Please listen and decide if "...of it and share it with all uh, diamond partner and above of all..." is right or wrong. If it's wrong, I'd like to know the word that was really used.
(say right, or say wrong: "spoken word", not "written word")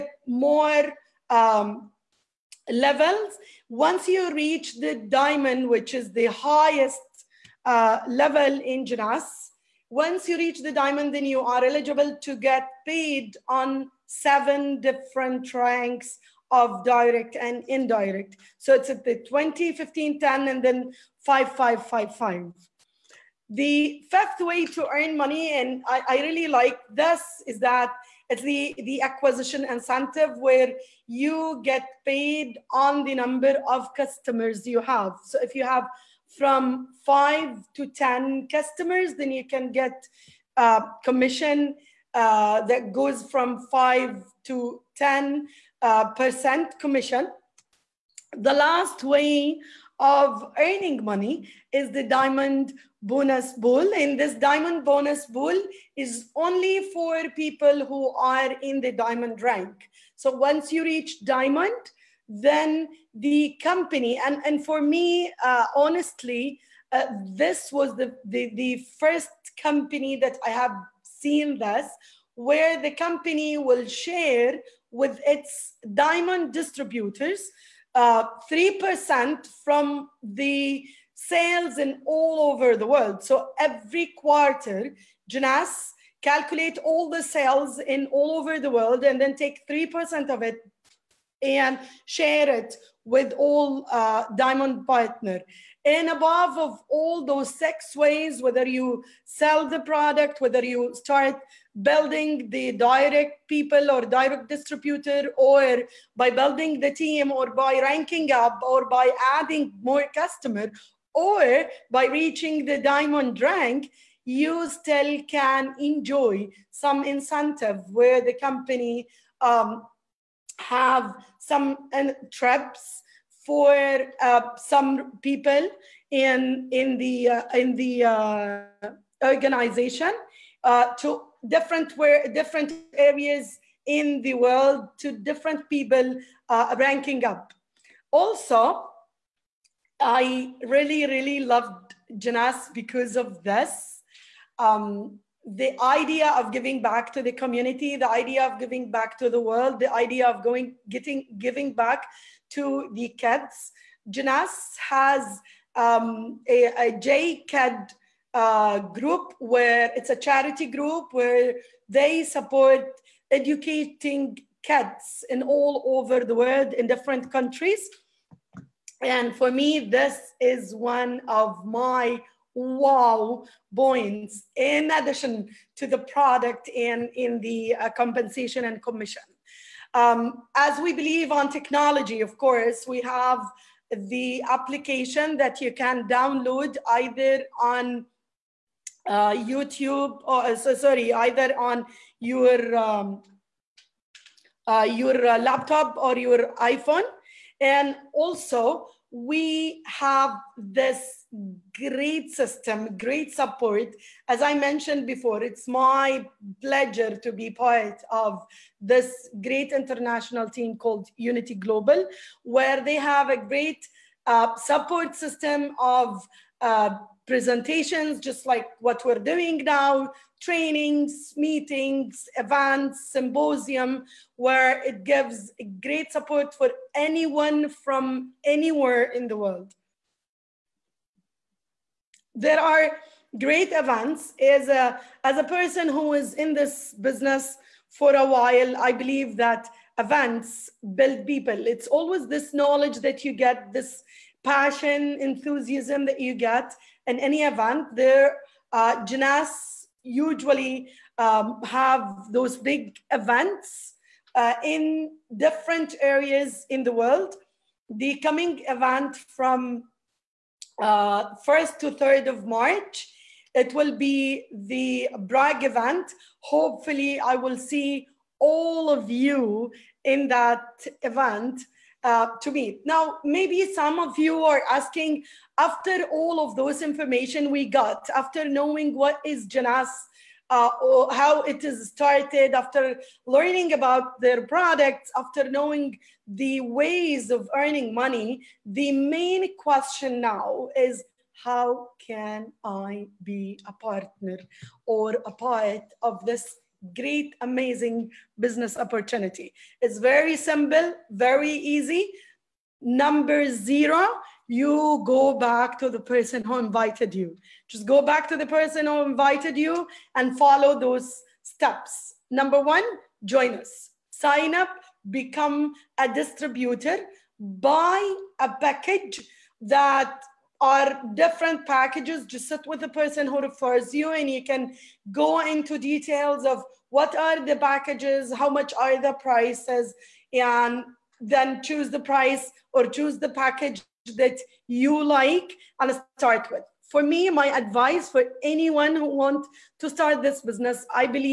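right.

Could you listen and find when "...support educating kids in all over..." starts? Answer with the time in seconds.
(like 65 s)
162 s.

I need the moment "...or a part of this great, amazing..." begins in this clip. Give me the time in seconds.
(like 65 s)
294 s.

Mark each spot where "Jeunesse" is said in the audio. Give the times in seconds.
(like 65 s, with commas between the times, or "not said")
8 s, 85 s, 142 s, 154 s, 249 s, 279 s.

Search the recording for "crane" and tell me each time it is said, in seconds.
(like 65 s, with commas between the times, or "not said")
not said.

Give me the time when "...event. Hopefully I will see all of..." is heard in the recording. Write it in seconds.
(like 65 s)
265 s.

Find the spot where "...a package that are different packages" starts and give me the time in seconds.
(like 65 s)
318 s.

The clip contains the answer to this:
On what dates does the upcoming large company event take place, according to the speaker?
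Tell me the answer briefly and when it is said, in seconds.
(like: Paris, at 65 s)
1st to 3rd of March, at 260 s.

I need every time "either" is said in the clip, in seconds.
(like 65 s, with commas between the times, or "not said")
186 s, 191 s.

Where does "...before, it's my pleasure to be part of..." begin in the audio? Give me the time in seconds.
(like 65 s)
205 s.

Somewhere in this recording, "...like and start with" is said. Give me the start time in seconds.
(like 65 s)
335 s.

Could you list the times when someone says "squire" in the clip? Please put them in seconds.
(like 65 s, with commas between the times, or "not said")
not said.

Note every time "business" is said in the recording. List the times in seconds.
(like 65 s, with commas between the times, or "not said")
237 s, 298 s, 340 s.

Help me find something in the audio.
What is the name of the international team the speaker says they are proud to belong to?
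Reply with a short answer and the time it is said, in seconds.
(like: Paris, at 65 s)
Unity Global, at 211 s.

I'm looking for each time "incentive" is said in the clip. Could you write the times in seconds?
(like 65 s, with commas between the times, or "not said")
29 s, 117 s.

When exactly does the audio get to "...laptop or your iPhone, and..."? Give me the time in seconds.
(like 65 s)
195 s.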